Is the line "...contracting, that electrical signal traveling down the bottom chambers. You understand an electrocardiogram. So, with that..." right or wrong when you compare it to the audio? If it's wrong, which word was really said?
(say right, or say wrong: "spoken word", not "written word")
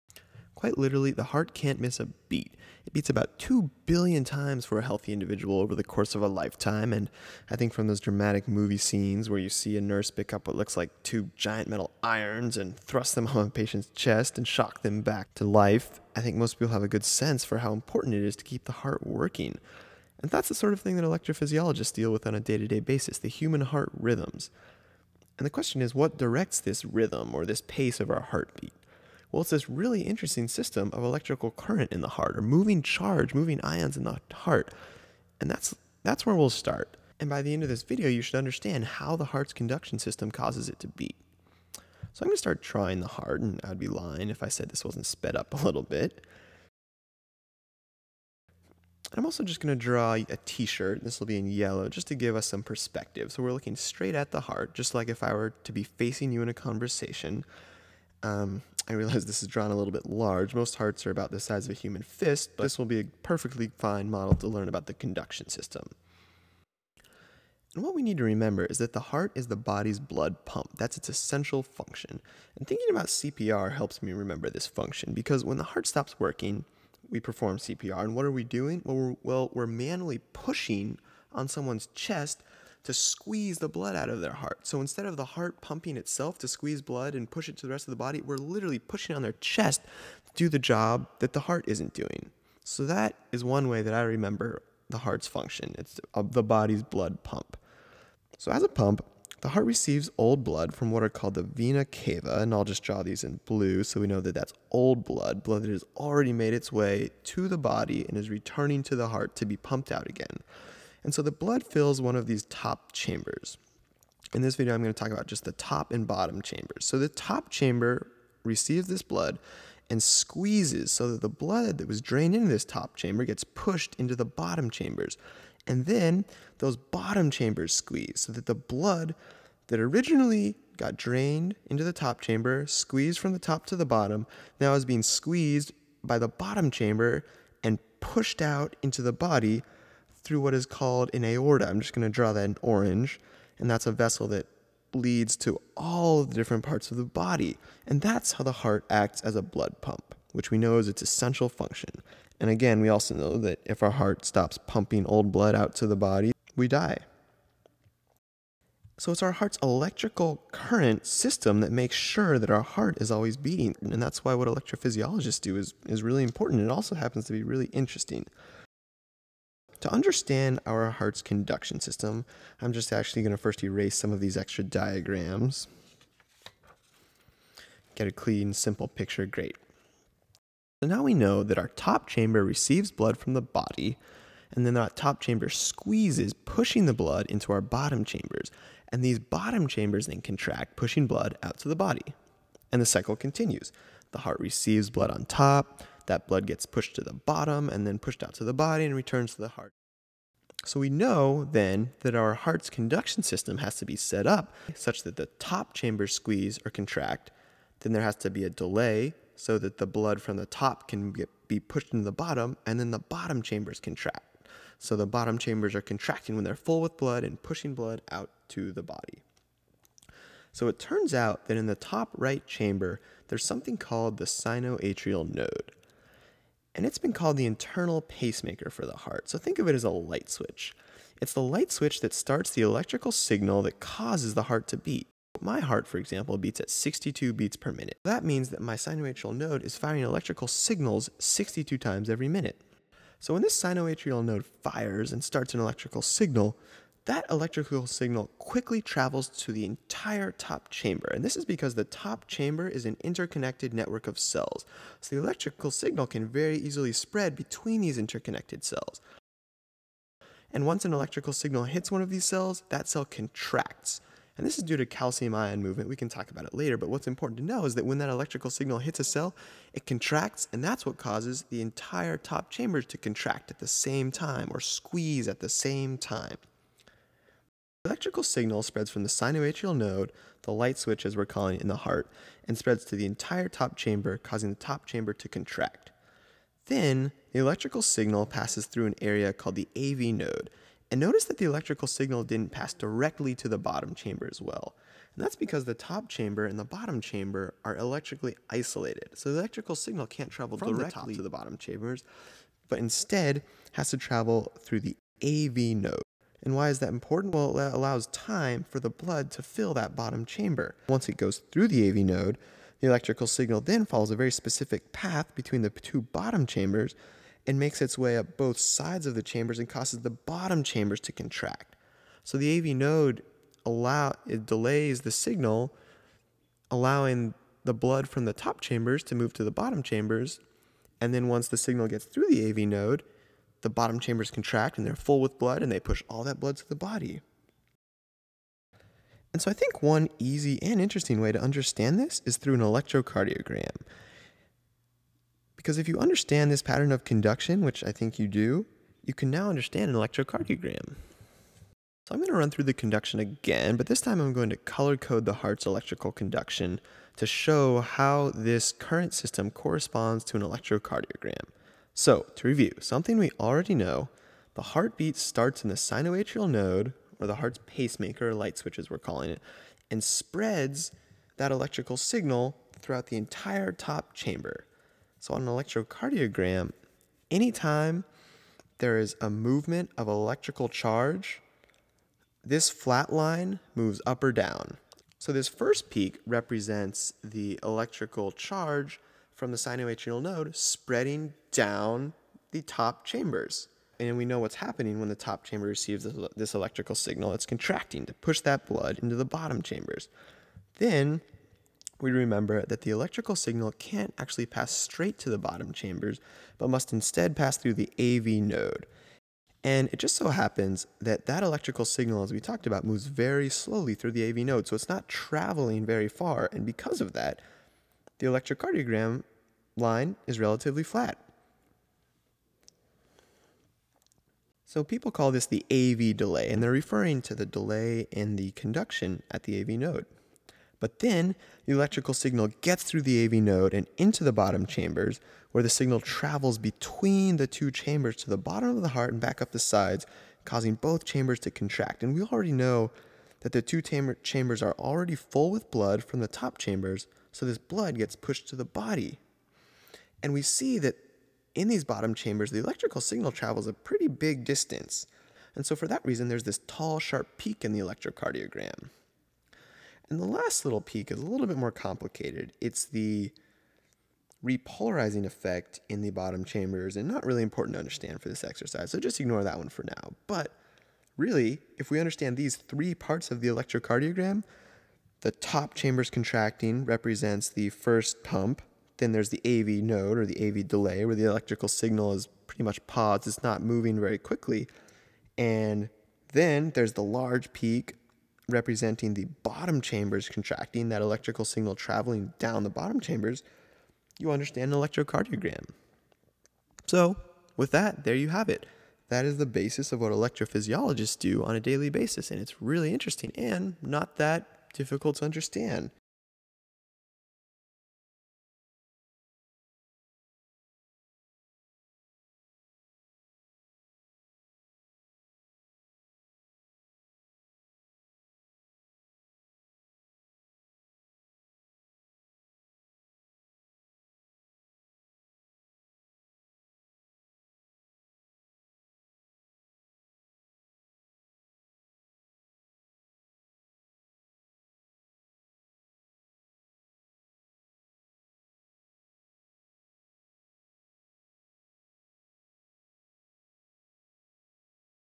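right.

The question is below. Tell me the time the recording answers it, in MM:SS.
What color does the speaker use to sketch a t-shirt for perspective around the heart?
00:51.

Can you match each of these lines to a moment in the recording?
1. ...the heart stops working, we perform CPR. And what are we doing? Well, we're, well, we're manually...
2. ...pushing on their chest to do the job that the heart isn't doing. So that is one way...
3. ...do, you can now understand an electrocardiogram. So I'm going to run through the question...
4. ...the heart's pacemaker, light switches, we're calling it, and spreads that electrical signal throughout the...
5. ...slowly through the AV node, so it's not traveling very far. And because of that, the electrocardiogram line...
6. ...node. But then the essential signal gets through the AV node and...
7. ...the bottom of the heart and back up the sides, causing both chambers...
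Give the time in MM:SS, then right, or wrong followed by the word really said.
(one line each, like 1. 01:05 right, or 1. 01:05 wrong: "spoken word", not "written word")
1. 01:15 right
2. 01:28 right
3. 05:48 wrong: "conduction", not "question"
4. 06:07 right
5. 06:53 right
6. 07:09 wrong: "electrical", not "essential"
7. 07:18 right.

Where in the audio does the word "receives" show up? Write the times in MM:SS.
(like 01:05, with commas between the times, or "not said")
01:39, 01:58, 03:02, 03:14, 06:35.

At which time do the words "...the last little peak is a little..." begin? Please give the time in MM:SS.
07:40.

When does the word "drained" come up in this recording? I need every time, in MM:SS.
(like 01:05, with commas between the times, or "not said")
02:02, 02:10.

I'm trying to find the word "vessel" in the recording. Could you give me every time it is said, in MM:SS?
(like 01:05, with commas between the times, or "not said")
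02:23.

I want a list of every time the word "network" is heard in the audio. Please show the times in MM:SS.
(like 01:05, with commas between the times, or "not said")
04:13.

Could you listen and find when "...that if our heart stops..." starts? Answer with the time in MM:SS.
02:33.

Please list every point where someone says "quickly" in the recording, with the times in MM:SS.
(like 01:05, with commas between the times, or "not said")
04:08, 08:04.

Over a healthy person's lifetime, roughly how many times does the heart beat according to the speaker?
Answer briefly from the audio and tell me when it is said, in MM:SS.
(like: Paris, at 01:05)
2 billion, at 00:03.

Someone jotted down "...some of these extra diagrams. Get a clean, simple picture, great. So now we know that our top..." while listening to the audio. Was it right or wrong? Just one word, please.
right.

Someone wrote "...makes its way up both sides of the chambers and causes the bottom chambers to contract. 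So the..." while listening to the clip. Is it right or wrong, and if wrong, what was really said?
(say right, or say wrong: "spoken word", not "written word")
right.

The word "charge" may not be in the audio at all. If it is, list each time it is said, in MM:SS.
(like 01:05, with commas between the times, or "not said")
00:32, 06:20, 06:28.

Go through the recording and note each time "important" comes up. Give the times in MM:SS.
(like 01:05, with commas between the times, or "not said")
00:17, 02:46, 04:27, 05:06, 07:47.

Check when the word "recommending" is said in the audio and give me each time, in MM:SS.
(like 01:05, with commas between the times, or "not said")
not said.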